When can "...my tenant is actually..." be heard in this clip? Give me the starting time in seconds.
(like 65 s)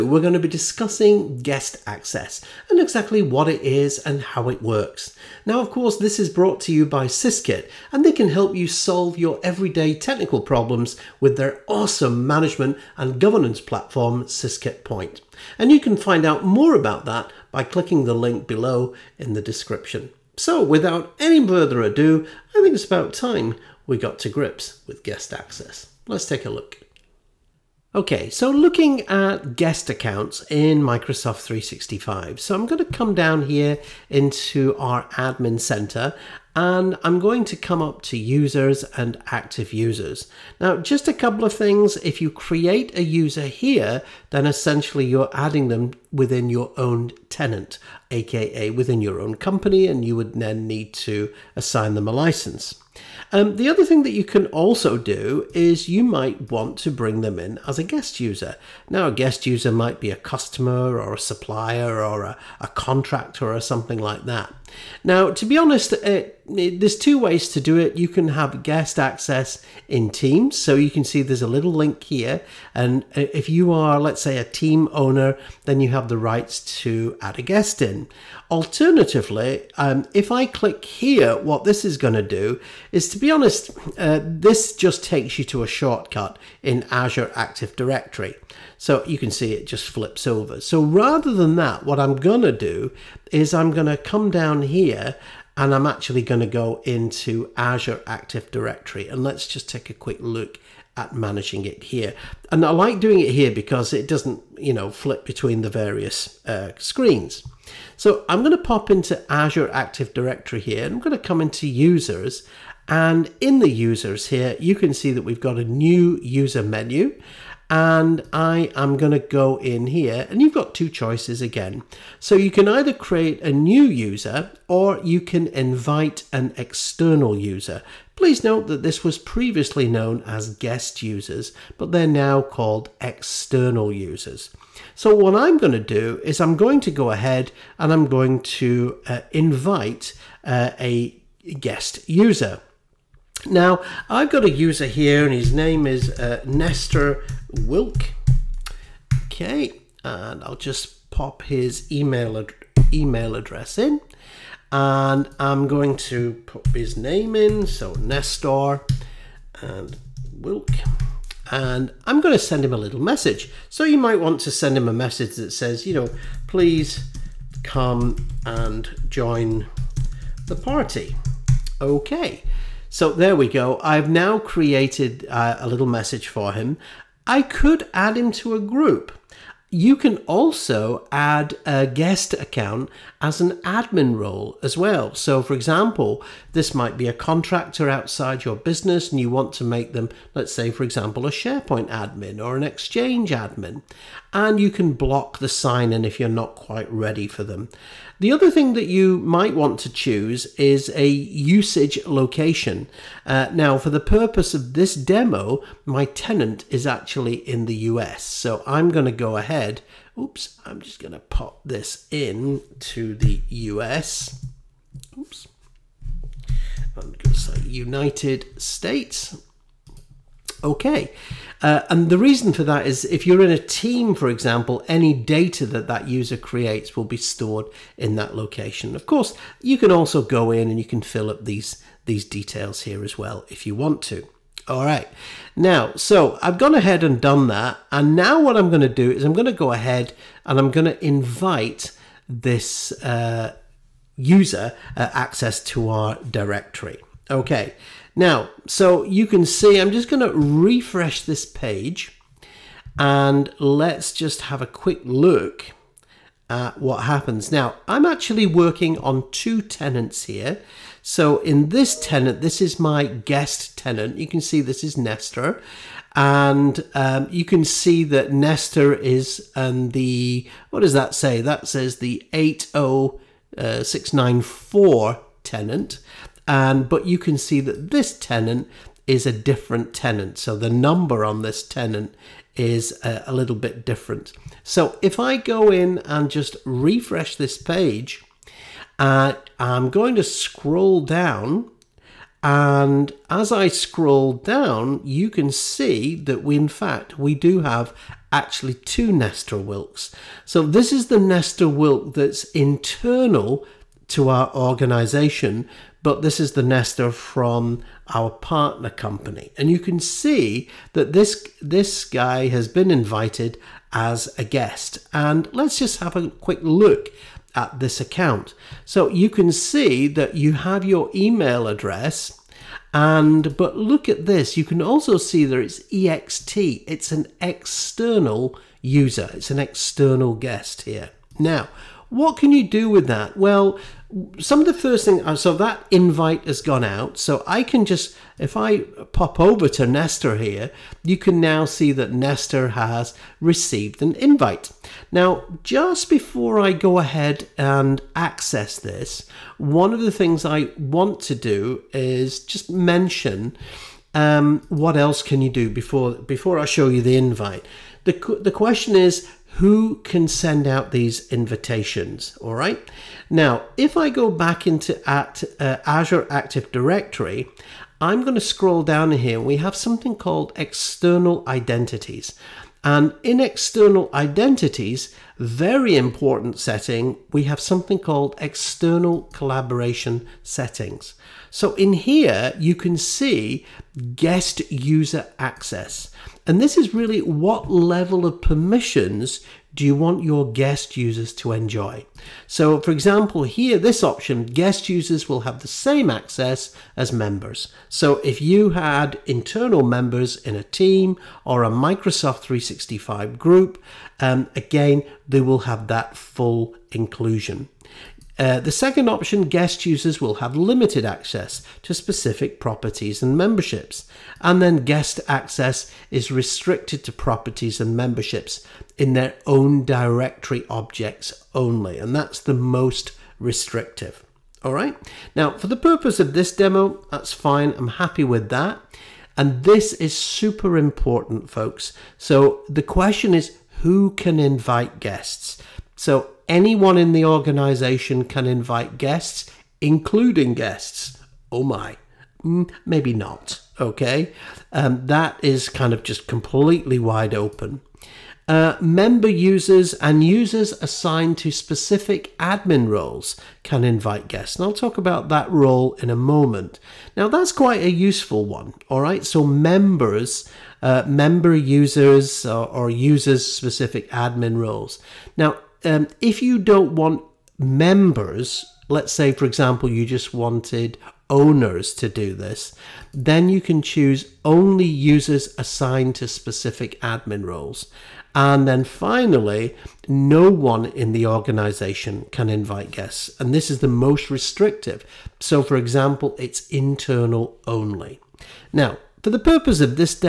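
205 s.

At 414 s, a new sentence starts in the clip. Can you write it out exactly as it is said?
And then guest access is restricted to properties and memberships in their own directory objects only.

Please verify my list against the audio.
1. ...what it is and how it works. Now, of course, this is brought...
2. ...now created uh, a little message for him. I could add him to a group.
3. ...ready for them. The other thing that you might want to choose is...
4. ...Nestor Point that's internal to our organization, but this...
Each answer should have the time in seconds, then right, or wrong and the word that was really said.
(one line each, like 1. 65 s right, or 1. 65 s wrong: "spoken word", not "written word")
1. 3 s right
2. 174 s right
3. 196 s right
4. 301 s wrong: "Wilk", not "Point".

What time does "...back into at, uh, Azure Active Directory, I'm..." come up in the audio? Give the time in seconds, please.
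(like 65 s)
364 s.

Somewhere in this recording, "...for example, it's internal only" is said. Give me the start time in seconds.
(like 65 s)
485 s.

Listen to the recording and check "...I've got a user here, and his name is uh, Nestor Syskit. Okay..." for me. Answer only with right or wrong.
wrong.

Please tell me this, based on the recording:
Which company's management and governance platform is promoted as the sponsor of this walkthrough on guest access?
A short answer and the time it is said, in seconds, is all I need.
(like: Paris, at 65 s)
Syskit Point, at 14 s.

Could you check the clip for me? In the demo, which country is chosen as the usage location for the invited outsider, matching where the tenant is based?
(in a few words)
United States.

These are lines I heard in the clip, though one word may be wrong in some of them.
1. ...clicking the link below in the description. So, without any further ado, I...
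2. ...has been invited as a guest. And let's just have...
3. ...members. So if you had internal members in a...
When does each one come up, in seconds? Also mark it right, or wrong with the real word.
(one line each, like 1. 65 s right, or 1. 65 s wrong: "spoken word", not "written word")
1. 17 s right
2. 312 s right
3. 397 s right.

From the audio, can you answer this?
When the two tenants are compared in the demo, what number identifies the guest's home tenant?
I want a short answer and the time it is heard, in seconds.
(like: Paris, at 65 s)
80694, at 272 s.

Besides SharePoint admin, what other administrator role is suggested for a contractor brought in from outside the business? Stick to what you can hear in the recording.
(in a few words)
Exchange admin.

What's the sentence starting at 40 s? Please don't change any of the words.
Now, just a couple of things.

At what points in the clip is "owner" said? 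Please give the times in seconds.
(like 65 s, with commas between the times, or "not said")
74 s, 471 s.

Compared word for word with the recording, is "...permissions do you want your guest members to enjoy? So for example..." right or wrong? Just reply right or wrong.
wrong.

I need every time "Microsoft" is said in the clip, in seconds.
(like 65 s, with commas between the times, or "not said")
30 s, 401 s.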